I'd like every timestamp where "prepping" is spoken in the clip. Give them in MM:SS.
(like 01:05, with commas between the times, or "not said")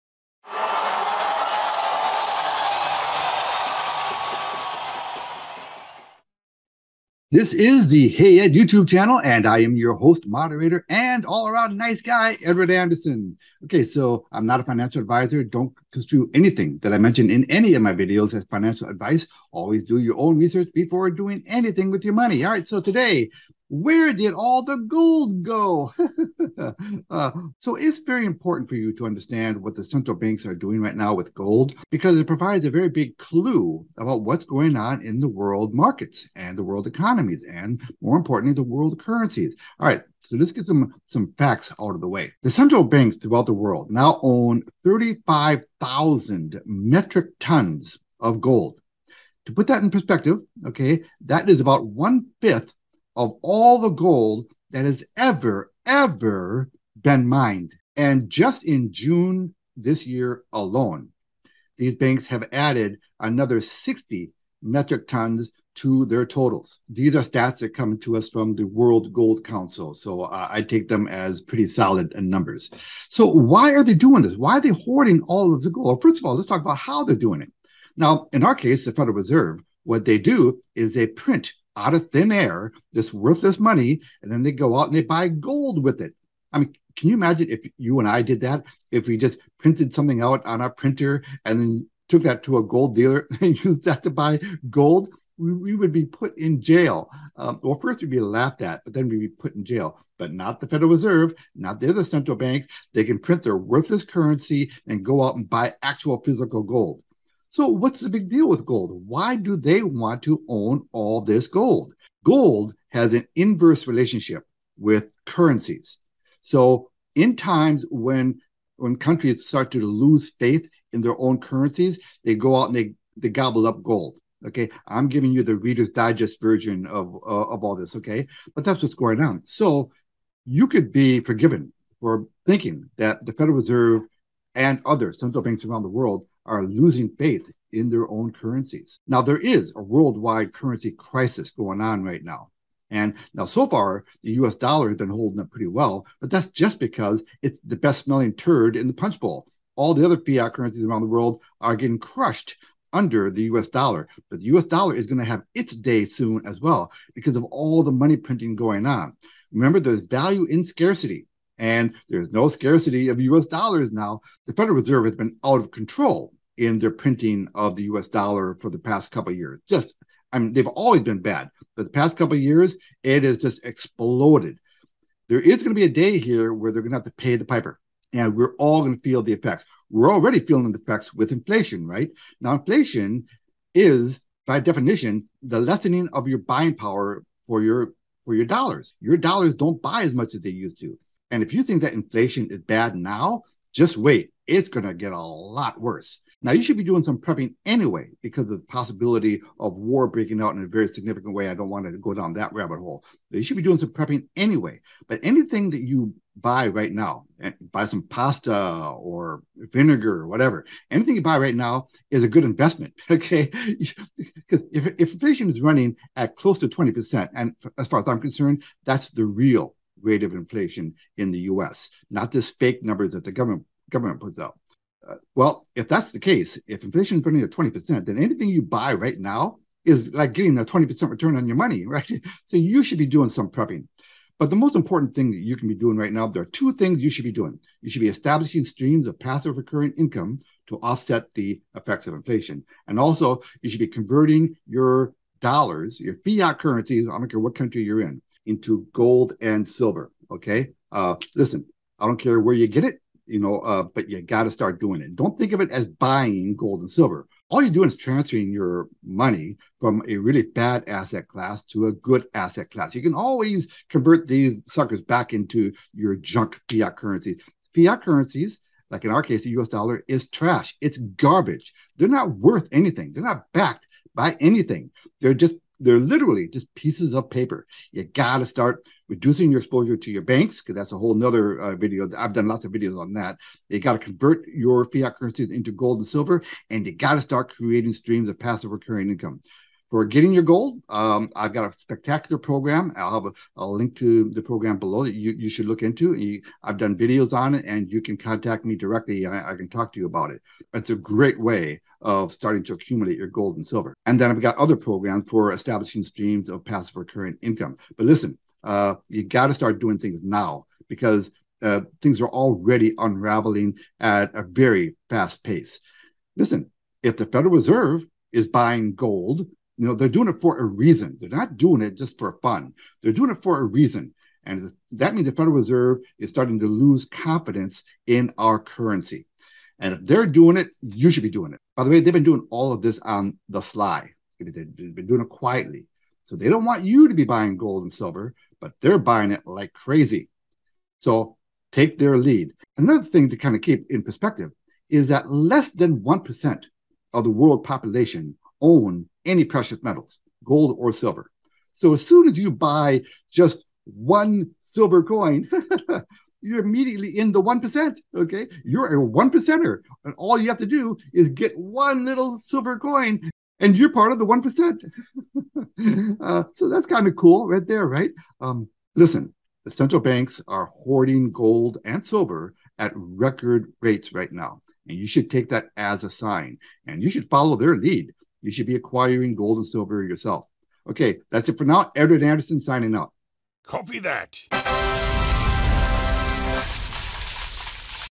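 03:17, 03:23, 03:53.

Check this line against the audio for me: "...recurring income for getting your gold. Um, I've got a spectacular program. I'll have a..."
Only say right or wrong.
right.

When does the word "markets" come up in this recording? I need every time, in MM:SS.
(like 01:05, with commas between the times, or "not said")
00:35.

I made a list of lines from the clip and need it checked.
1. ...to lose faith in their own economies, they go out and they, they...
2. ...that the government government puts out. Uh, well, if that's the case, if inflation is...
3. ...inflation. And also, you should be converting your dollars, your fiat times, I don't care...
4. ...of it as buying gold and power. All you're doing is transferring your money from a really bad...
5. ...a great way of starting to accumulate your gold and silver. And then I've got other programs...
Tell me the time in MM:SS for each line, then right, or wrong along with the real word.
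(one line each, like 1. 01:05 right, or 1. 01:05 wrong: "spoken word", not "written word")
1. 01:59 wrong: "currencies", not "economies"
2. 03:43 right
3. 04:02 wrong: "currencies", not "times"
4. 04:15 wrong: "silver", not "power"
5. 05:00 right.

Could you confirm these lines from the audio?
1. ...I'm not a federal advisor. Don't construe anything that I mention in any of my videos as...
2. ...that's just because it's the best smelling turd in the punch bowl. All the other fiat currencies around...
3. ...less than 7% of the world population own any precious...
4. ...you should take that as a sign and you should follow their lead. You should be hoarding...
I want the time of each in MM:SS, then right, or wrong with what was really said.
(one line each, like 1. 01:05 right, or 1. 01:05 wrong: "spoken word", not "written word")
1. 00:14 wrong: "financial", not "federal"
2. 02:26 right
3. 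05:45 wrong: "1", not "7"
4. 06:14 wrong: "acquiring", not "hoarding".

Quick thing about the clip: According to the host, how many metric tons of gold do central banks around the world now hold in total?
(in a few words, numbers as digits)
35,000 metric tons.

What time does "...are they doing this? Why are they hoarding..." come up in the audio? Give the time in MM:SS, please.
01:13.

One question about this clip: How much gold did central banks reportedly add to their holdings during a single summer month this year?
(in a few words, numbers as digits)
60 metric tons.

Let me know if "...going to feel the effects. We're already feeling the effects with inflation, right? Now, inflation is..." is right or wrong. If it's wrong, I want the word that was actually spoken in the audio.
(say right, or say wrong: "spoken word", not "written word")
right.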